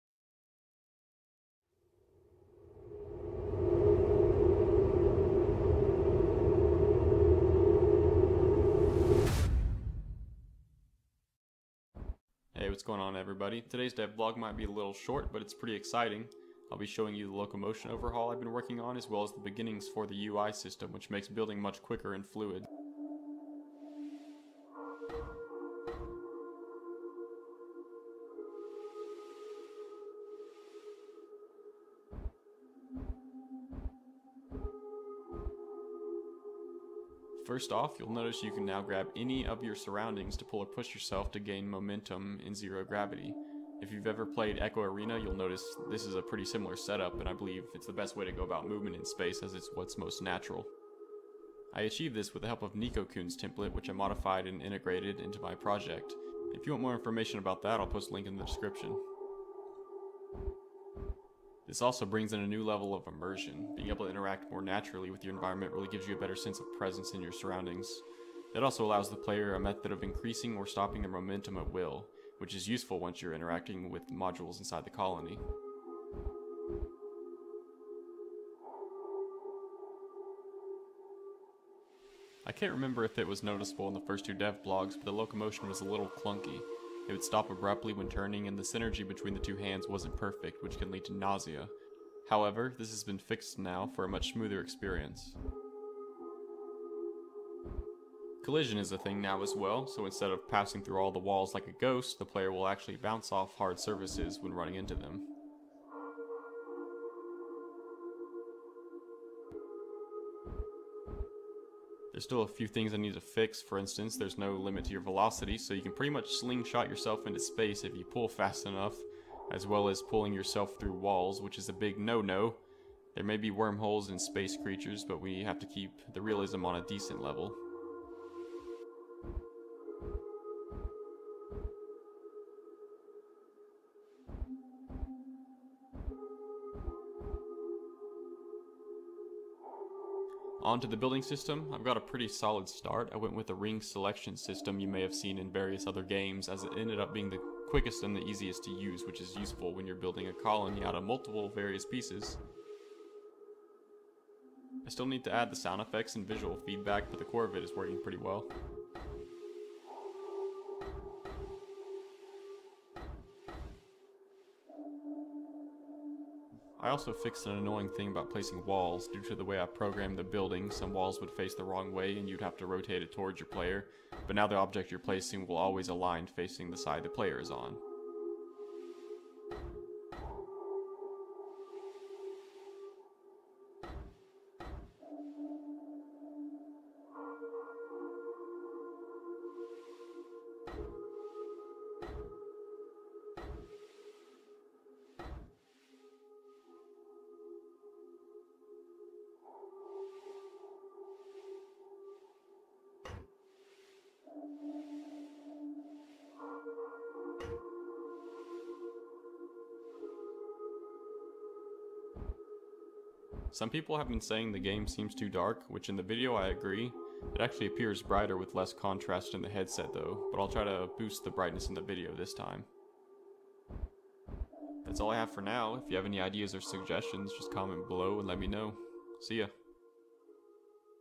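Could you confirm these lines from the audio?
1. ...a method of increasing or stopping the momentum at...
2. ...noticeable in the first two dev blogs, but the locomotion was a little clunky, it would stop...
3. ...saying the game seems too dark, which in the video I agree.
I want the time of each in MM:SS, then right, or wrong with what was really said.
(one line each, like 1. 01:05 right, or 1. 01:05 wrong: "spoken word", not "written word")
1. 01:09 right
2. 01:23 right
3. 03:34 right.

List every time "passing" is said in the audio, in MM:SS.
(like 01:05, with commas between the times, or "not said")
01:40.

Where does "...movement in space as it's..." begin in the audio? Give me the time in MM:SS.
00:48.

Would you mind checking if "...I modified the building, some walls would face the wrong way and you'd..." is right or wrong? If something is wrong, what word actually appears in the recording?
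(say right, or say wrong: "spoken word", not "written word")
wrong: "programmed", not "modified".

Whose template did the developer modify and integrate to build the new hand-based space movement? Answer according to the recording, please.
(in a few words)
NikoKun.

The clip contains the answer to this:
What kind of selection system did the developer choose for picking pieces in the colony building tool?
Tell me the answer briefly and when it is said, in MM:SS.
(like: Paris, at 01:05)
Ring selection system, at 02:23.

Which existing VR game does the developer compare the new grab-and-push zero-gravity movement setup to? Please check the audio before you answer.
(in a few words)
Echo Arena.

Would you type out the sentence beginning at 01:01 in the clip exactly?
This also brings in a new level of immersion.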